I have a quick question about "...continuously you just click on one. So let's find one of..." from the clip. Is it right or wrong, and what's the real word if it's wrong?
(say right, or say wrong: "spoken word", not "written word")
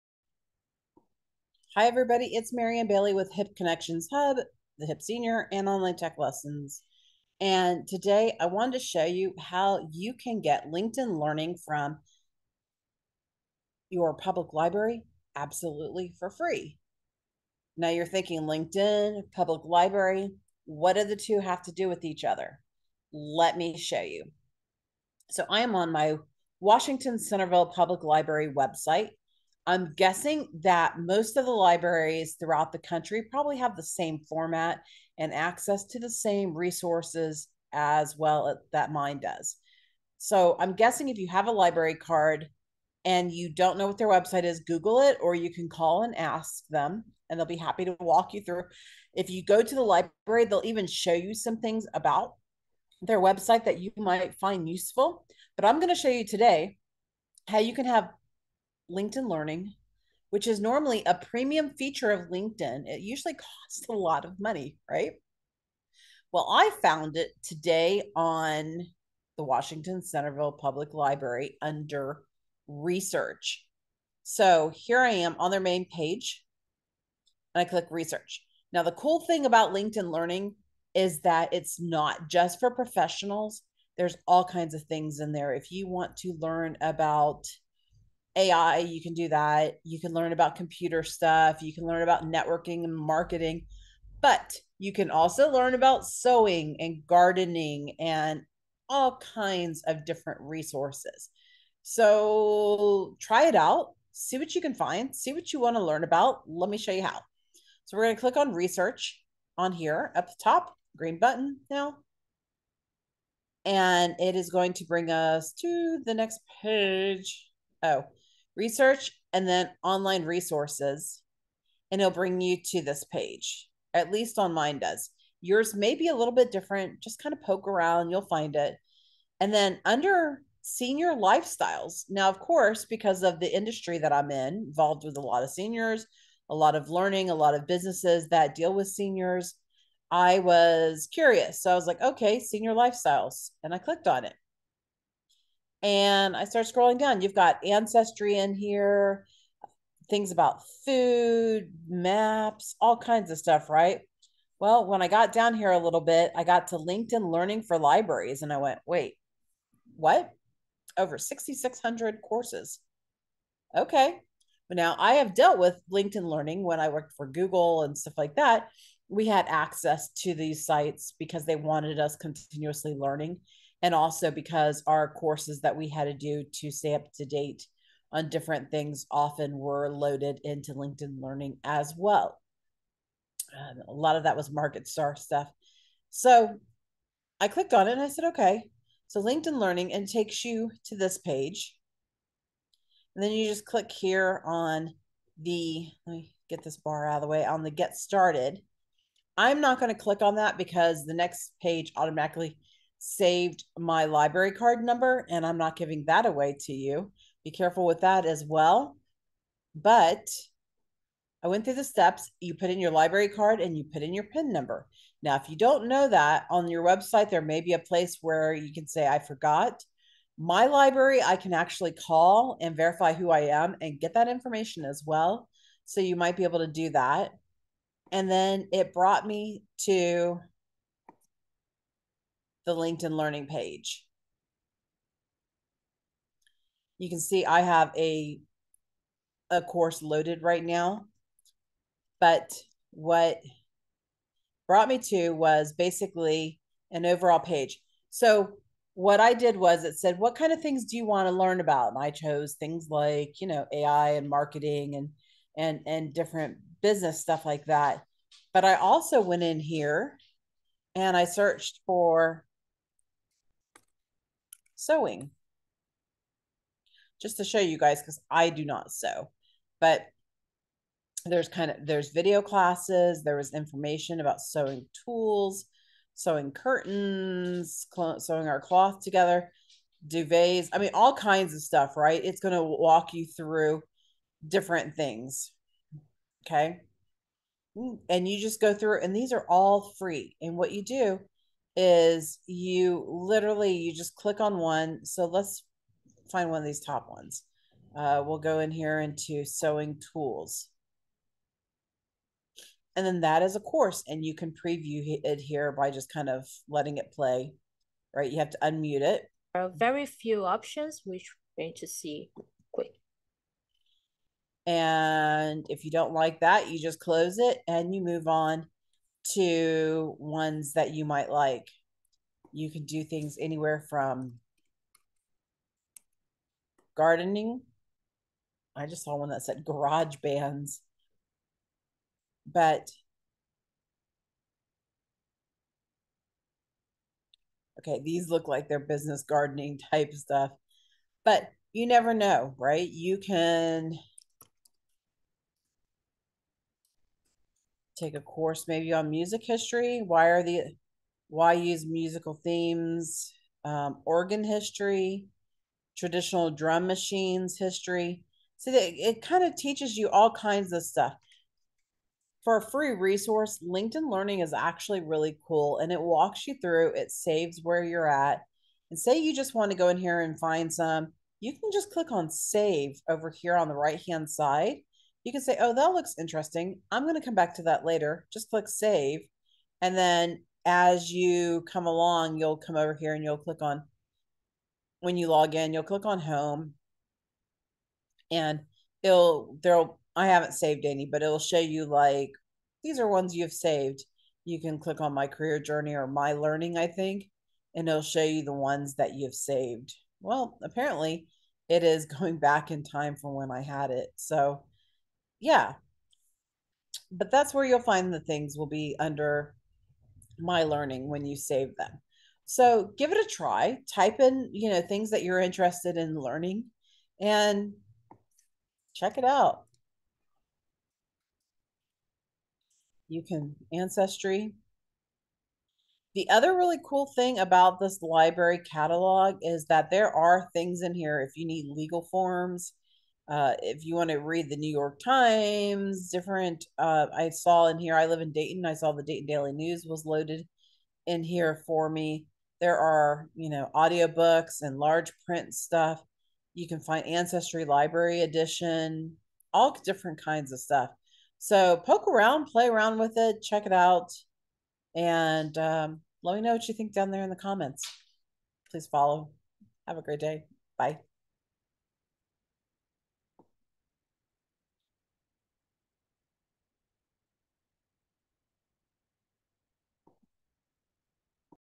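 wrong: "literally", not "continuously".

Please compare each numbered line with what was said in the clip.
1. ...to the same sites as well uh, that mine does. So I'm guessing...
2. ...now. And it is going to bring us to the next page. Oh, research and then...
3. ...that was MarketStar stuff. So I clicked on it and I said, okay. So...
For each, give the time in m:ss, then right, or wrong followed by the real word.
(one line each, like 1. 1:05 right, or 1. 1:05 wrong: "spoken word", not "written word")
1. 0:35 wrong: "resources", not "sites"
2. 1:51 right
3. 3:04 right.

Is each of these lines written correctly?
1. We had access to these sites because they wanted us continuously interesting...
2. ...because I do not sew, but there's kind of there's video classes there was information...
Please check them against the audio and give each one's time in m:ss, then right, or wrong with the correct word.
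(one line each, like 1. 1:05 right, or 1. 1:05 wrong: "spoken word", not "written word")
1. 2:49 wrong: "learning", not "interesting"
2. 4:28 right.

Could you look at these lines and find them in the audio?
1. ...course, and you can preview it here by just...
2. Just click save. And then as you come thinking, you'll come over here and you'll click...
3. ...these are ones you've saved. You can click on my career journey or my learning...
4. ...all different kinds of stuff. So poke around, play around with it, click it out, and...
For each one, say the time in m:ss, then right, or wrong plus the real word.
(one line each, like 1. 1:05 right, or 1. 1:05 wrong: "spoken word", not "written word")
1. 5:03 right
2. 6:18 wrong: "along", not "thinking"
3. 6:32 right
4. 7:29 wrong: "check", not "click".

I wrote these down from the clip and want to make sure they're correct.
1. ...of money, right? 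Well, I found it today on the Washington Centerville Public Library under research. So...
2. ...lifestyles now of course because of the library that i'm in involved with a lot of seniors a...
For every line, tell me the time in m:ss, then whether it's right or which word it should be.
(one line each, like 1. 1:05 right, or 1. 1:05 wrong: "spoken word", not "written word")
1. 1:04 right
2. 2:11 wrong: "industry", not "library".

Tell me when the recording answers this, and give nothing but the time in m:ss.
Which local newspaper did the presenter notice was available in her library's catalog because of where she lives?
7:19.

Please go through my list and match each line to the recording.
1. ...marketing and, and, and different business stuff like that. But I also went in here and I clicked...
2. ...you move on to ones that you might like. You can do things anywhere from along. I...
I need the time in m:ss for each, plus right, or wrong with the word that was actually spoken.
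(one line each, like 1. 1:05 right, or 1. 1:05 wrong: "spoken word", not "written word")
1. 4:14 wrong: "searched", not "clicked"
2. 5:17 wrong: "gardening", not "along".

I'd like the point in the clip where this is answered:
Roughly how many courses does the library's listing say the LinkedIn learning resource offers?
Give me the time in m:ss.
2:40.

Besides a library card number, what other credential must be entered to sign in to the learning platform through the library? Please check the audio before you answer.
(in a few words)
PIN number.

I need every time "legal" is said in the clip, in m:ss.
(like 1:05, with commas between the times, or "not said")
7:11.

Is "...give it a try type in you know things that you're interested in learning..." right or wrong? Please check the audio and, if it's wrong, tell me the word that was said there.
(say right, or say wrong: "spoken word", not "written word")
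right.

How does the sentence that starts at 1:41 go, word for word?
So try it out, see what you can find, see what you want to learn about.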